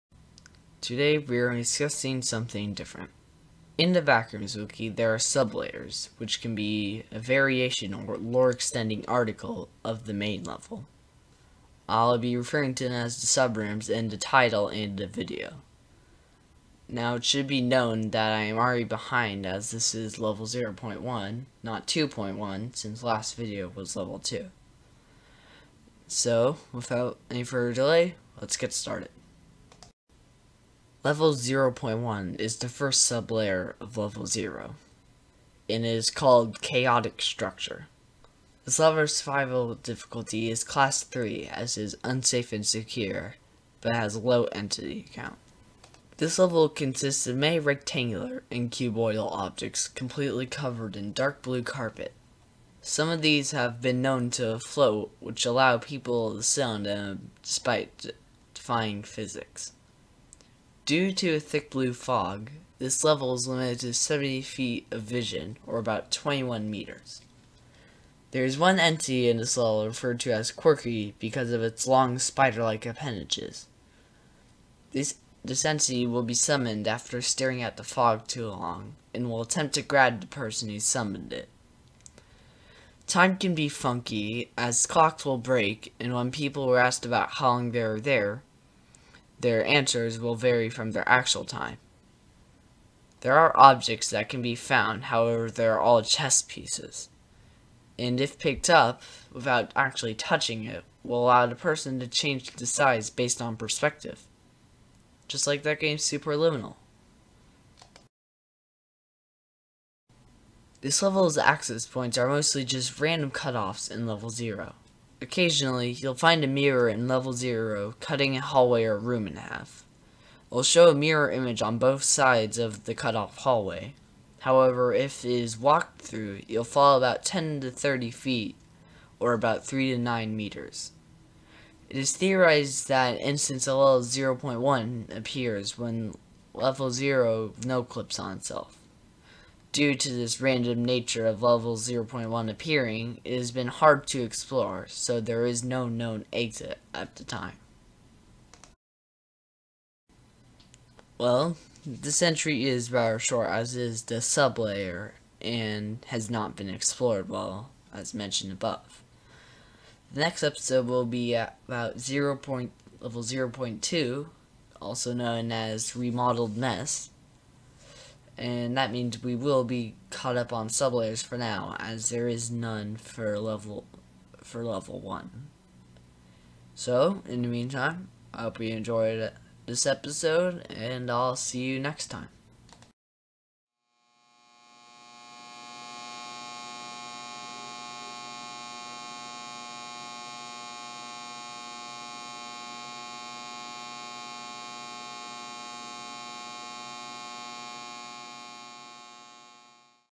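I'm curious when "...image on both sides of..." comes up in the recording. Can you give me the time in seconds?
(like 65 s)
121 s.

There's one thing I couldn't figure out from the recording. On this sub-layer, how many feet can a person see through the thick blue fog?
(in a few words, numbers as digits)
70 feet.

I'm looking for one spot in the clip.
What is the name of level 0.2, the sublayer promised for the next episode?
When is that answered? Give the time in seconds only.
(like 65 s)
165 s.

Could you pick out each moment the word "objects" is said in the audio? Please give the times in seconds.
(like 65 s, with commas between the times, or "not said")
49 s, 93 s.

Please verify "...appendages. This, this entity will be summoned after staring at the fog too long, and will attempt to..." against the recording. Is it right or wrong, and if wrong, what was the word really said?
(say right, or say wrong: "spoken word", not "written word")
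right.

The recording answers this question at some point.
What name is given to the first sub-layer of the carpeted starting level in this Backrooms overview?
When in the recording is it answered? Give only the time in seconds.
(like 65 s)
36 s.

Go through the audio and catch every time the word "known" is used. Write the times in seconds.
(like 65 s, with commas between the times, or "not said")
17 s, 54 s, 145 s, 165 s.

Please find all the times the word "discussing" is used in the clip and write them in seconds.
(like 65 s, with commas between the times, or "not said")
1 s.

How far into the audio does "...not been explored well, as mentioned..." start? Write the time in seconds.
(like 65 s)
156 s.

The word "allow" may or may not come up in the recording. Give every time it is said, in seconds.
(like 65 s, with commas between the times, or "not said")
55 s, 101 s.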